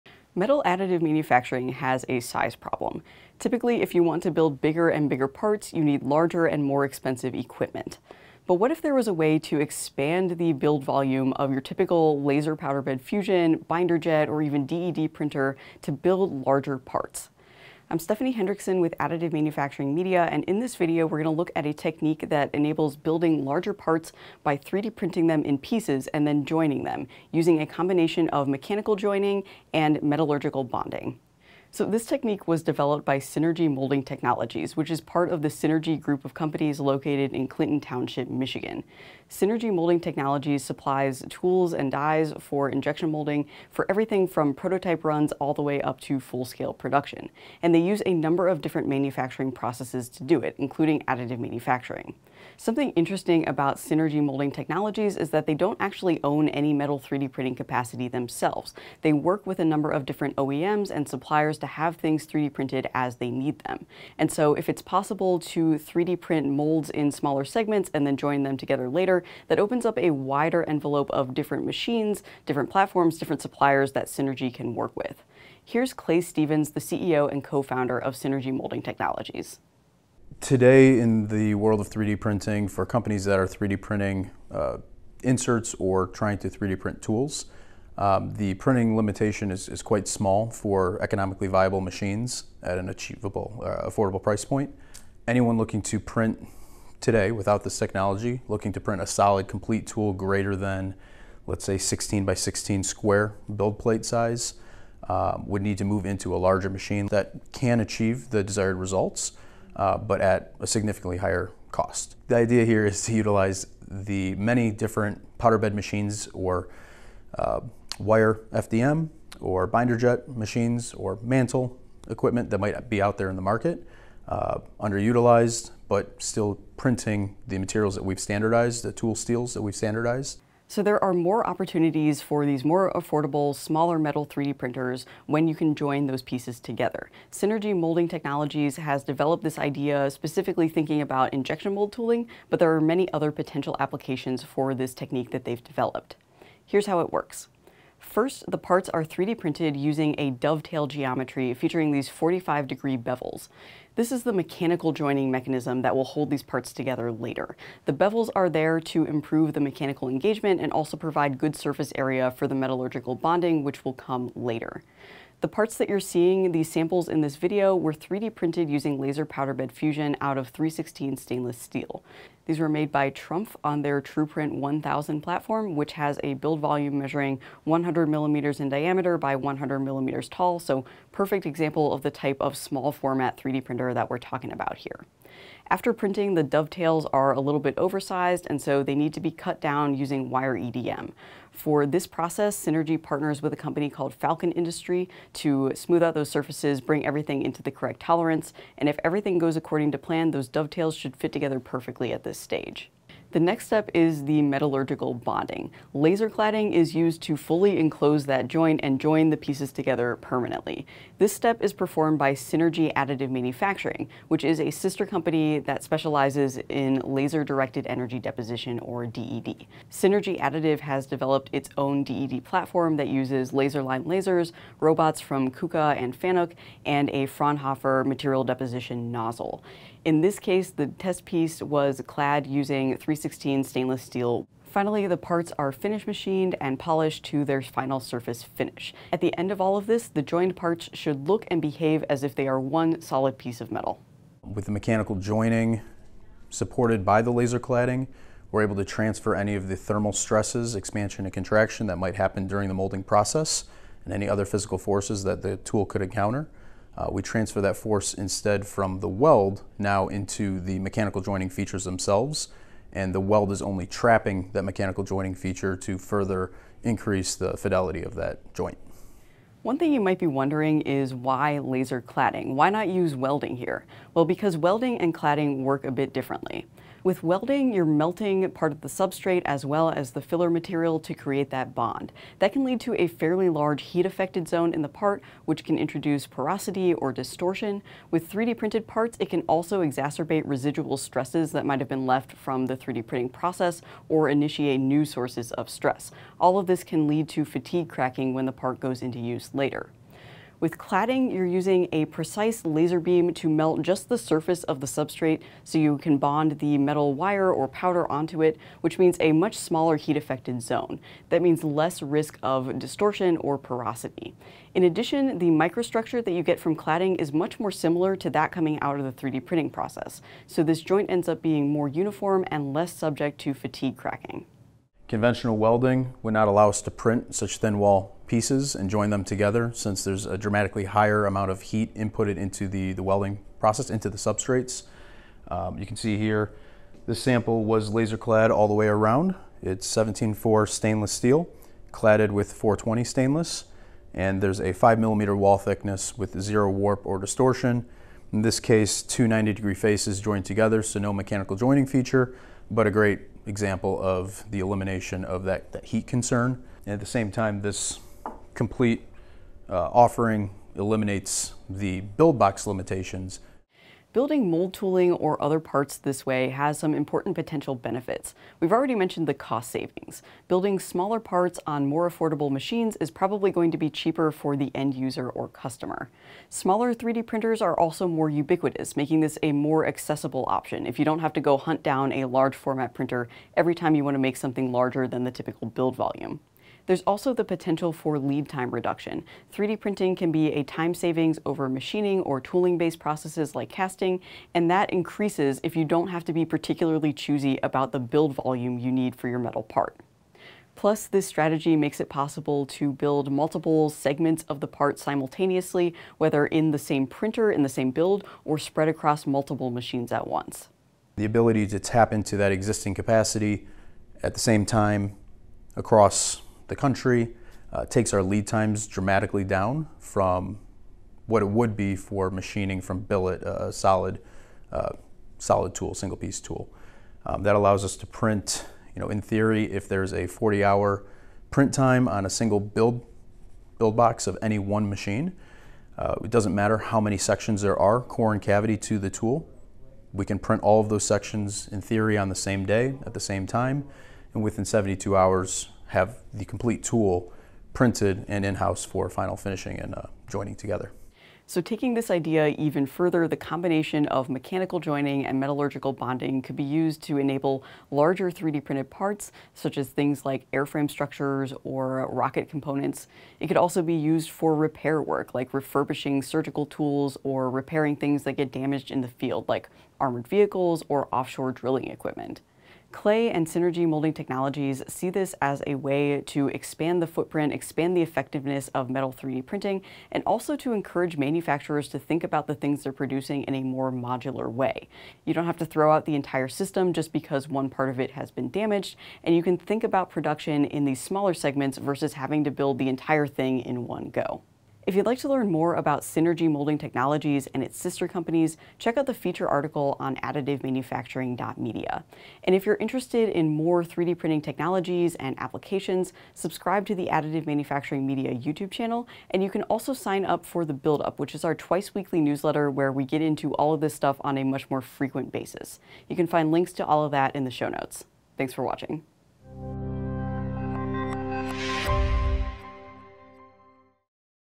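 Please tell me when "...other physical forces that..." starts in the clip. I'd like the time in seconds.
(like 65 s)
254 s.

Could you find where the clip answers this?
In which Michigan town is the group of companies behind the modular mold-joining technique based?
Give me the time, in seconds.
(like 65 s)
37 s.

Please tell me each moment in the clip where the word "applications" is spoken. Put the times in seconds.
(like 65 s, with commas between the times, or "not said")
143 s, 505 s.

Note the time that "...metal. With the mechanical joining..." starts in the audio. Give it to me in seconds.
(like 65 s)
243 s.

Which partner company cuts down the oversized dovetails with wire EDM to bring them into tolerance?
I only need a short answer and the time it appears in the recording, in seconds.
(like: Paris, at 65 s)
Falcon Industry, at 194 s.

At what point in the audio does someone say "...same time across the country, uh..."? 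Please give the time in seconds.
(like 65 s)
414 s.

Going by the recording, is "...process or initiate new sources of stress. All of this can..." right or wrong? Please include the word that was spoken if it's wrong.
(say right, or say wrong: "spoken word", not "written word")
right.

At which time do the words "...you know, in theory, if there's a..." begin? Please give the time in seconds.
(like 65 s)
428 s.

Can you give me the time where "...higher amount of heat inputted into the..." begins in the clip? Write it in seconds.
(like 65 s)
330 s.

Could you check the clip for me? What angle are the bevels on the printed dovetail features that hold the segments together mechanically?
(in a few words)
45 degrees.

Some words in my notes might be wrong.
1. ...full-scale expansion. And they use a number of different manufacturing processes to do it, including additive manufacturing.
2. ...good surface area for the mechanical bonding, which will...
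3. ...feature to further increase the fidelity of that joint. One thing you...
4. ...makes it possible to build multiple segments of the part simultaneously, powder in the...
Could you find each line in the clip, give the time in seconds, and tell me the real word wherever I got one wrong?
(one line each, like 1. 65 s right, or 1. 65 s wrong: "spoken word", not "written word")
1. 46 s wrong: "production", not "expansion"
2. 161 s wrong: "metallurgical", not "mechanical"
3. 265 s right
4. 401 s wrong: "whether", not "powder".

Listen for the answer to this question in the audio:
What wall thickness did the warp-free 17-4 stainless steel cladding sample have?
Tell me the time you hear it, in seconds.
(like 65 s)
344 s.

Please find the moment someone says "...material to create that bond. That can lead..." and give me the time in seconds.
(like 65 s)
280 s.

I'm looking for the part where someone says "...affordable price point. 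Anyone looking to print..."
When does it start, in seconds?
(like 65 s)
93 s.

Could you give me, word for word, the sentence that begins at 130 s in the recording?
So there are more opportunities for these more affordable, smaller metal 3D printers when you can join those pieces together.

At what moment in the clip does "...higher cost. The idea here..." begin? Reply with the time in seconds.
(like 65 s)
111 s.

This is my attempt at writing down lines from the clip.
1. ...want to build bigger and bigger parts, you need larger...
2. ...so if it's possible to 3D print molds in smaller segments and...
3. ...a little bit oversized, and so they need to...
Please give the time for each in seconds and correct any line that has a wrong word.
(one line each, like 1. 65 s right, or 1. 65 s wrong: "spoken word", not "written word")
1. 4 s right
2. 64 s right
3. 187 s right.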